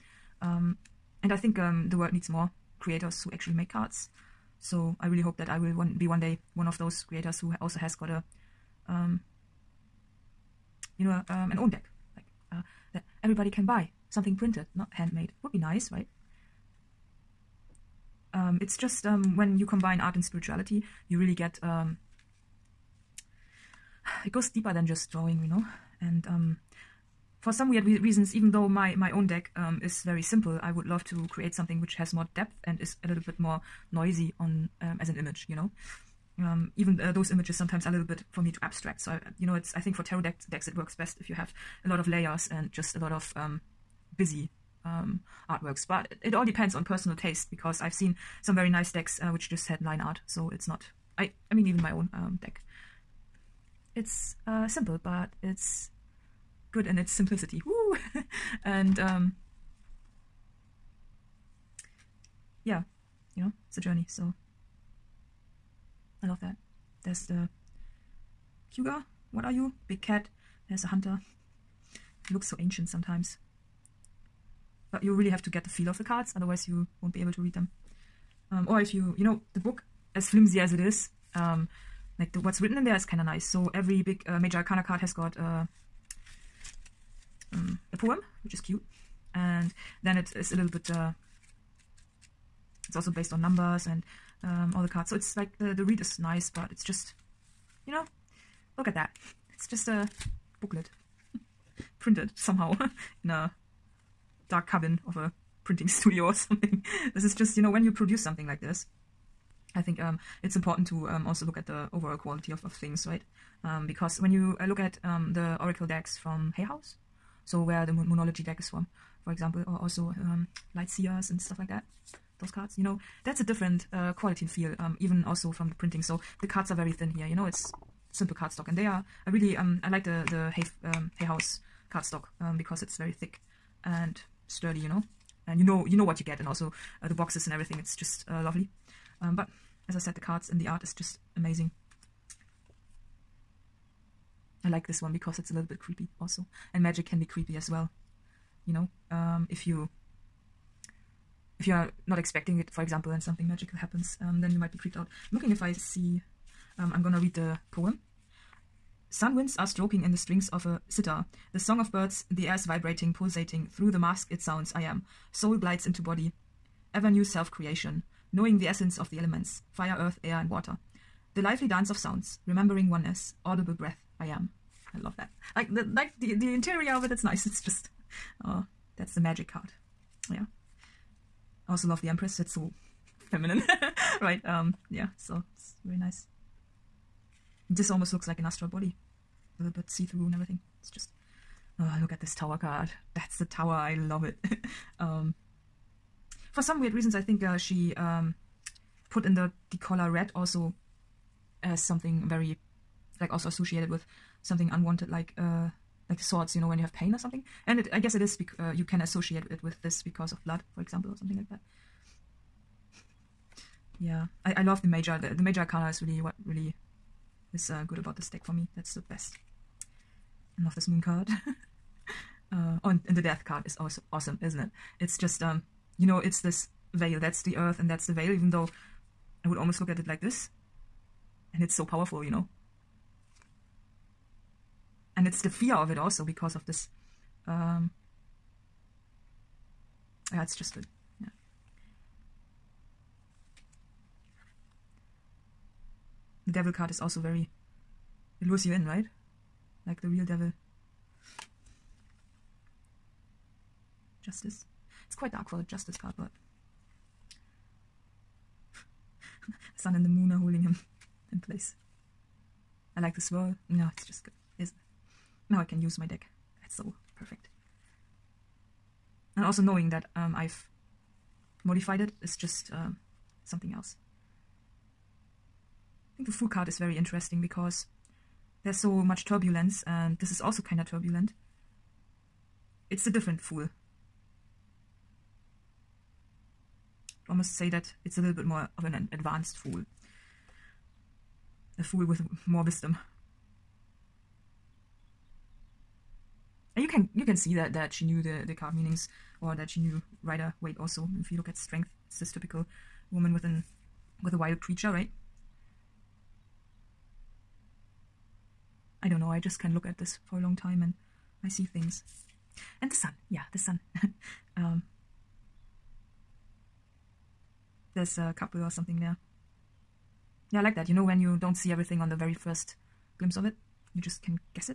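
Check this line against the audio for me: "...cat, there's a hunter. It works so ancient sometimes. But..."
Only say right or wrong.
wrong.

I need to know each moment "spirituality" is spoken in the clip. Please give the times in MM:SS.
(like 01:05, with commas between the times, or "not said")
00:20.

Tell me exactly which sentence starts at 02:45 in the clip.
Soul glides into body, ever new self creation, knowing the essence of the elements fire, earth, air, and water.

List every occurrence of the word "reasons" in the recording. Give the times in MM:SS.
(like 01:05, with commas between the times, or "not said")
00:27, 03:16.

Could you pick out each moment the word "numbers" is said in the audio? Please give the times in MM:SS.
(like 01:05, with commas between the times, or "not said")
01:33.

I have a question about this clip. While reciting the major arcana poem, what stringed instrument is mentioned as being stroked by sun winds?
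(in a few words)
sitar.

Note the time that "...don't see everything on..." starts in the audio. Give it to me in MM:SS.
05:21.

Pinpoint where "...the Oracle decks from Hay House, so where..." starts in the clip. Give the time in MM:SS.
01:55.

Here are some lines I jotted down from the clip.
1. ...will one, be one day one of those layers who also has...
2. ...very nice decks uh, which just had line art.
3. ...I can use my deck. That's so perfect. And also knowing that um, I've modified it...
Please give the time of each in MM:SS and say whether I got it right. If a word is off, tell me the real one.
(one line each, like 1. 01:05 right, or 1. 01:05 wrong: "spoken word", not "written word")
1. 00:05 wrong: "creators", not "layers"
2. 00:48 right
3. 04:25 right.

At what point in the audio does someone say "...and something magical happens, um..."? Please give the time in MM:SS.
02:33.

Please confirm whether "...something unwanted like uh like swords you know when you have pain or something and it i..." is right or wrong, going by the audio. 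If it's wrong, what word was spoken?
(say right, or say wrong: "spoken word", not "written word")
right.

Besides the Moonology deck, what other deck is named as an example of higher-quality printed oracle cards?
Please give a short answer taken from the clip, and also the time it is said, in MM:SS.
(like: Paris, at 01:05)
Lightseers, at 02:00.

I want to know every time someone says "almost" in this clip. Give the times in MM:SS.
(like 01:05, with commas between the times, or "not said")
03:07, 03:49, 04:47.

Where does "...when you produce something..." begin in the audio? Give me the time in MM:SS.
01:47.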